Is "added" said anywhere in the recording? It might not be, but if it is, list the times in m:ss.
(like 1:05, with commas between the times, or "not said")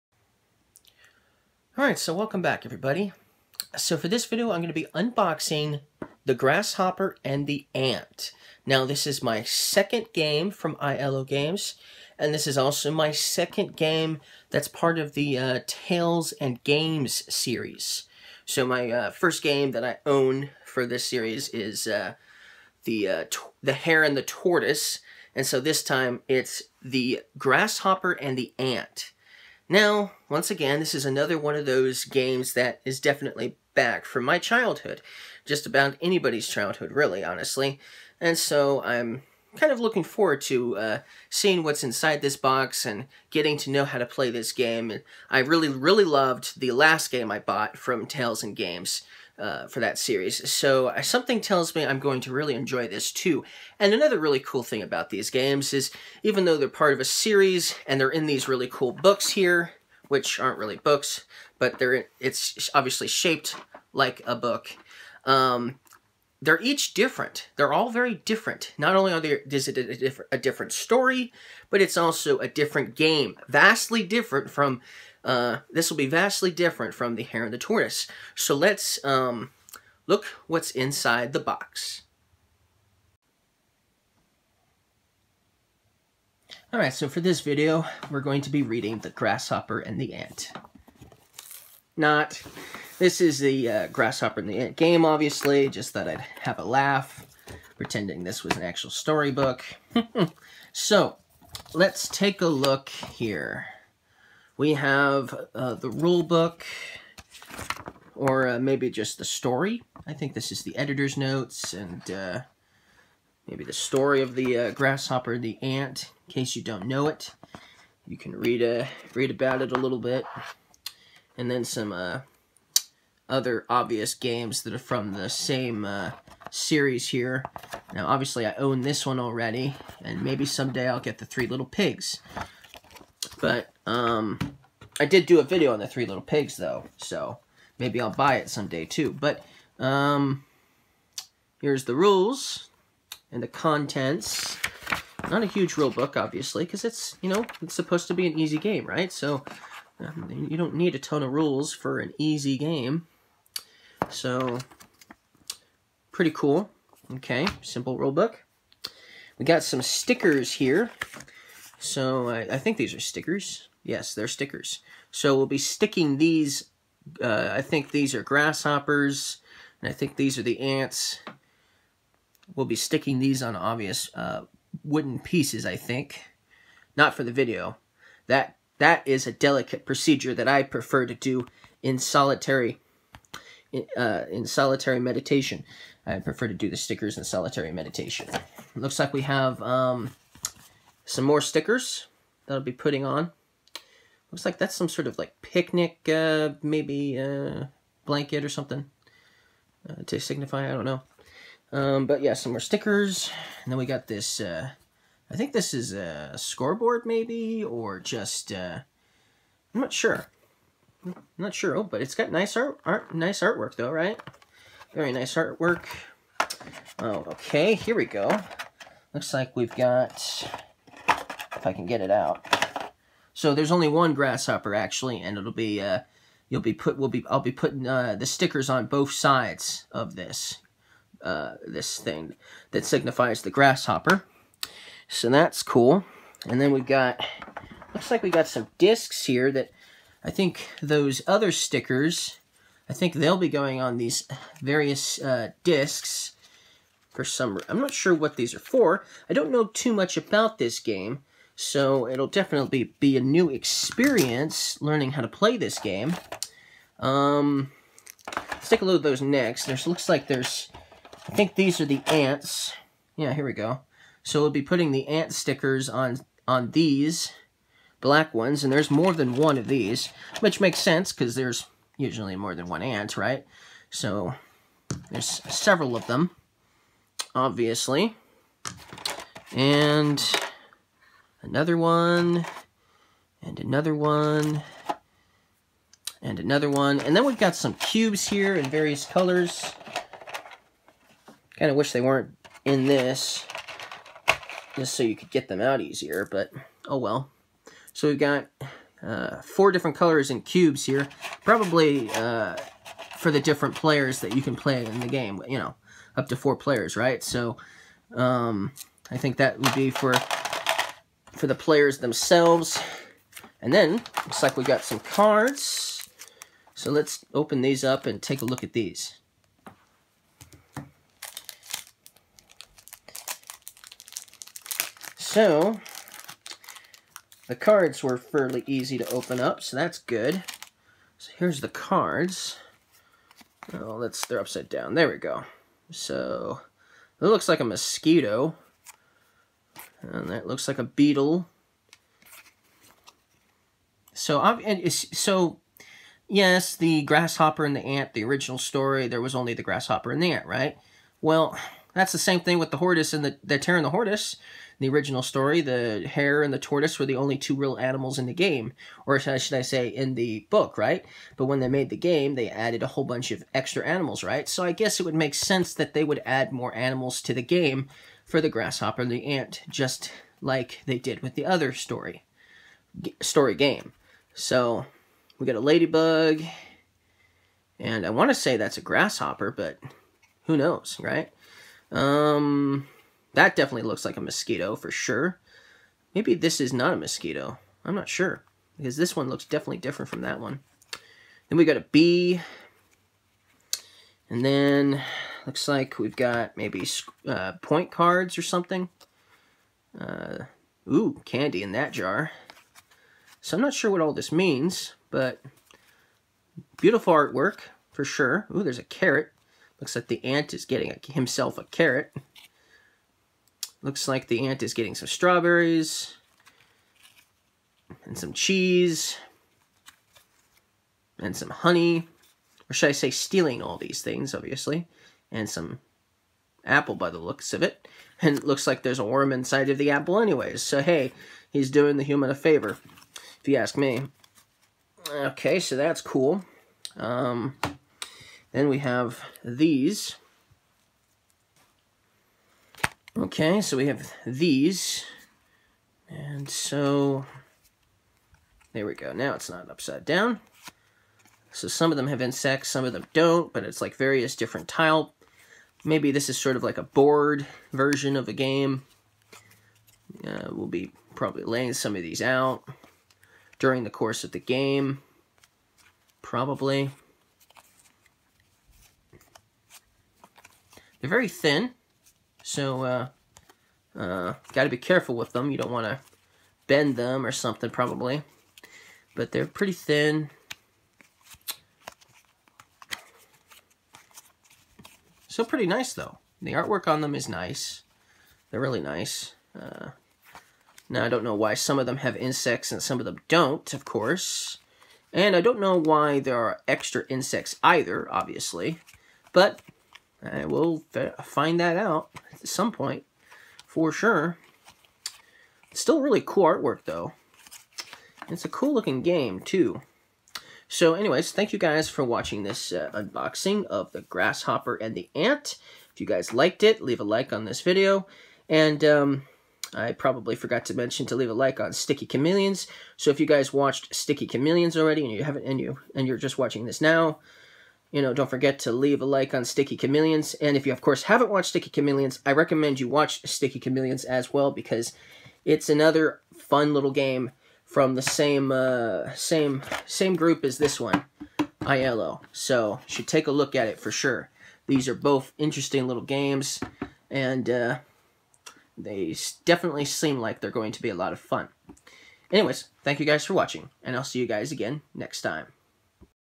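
6:02.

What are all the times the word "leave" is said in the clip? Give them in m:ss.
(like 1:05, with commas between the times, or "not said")
8:36, 8:41, 8:48.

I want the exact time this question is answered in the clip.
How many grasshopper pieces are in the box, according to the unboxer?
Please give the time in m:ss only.
3:43.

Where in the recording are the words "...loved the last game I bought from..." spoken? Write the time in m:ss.
0:46.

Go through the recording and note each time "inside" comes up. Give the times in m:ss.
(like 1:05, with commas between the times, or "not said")
0:41, 1:20, 7:09.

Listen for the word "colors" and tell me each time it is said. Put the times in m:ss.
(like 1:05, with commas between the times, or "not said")
4:49, 4:59.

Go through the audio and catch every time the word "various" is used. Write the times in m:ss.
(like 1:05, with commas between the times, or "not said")
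4:04, 4:48, 7:33.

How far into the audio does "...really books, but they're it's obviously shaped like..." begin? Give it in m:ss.
1:00.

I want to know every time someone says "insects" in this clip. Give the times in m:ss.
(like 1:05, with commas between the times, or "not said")
7:32, 8:12, 8:17.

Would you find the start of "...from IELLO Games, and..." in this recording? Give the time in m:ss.
0:10.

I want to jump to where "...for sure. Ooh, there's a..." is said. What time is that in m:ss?
6:47.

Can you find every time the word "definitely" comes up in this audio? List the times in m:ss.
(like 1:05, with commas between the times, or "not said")
0:32, 4:12, 6:23, 6:29, 9:09.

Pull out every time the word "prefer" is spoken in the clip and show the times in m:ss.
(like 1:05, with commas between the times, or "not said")
3:00, 3:06.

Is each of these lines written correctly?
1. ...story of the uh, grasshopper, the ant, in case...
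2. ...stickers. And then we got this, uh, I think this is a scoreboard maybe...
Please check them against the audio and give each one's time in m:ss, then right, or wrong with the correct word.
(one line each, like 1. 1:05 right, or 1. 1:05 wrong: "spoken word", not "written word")
1. 1:53 right
2. 3:22 right.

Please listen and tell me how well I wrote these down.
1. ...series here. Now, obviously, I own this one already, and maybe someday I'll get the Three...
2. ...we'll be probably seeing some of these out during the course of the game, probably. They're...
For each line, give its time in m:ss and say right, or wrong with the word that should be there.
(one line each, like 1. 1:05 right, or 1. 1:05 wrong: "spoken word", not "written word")
1. 2:06 right
2. 7:40 wrong: "laying", not "seeing".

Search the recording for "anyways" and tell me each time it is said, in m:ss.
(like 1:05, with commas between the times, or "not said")
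7:10, 8:30, 9:12.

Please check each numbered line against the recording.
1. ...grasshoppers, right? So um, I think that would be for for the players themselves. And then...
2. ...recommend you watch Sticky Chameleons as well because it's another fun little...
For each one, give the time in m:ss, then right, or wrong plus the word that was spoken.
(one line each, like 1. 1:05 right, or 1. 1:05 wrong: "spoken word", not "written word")
1. 5:06 wrong: "players", not "grasshoppers"
2. 8:52 right.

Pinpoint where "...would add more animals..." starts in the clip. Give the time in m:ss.
6:06.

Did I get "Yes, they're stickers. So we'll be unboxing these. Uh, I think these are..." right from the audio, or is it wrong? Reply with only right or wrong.
wrong.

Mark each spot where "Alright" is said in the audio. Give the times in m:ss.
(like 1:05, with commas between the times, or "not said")
0:01, 1:26.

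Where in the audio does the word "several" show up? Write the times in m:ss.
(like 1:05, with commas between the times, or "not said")
4:35.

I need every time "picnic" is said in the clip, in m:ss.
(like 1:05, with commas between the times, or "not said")
3:15.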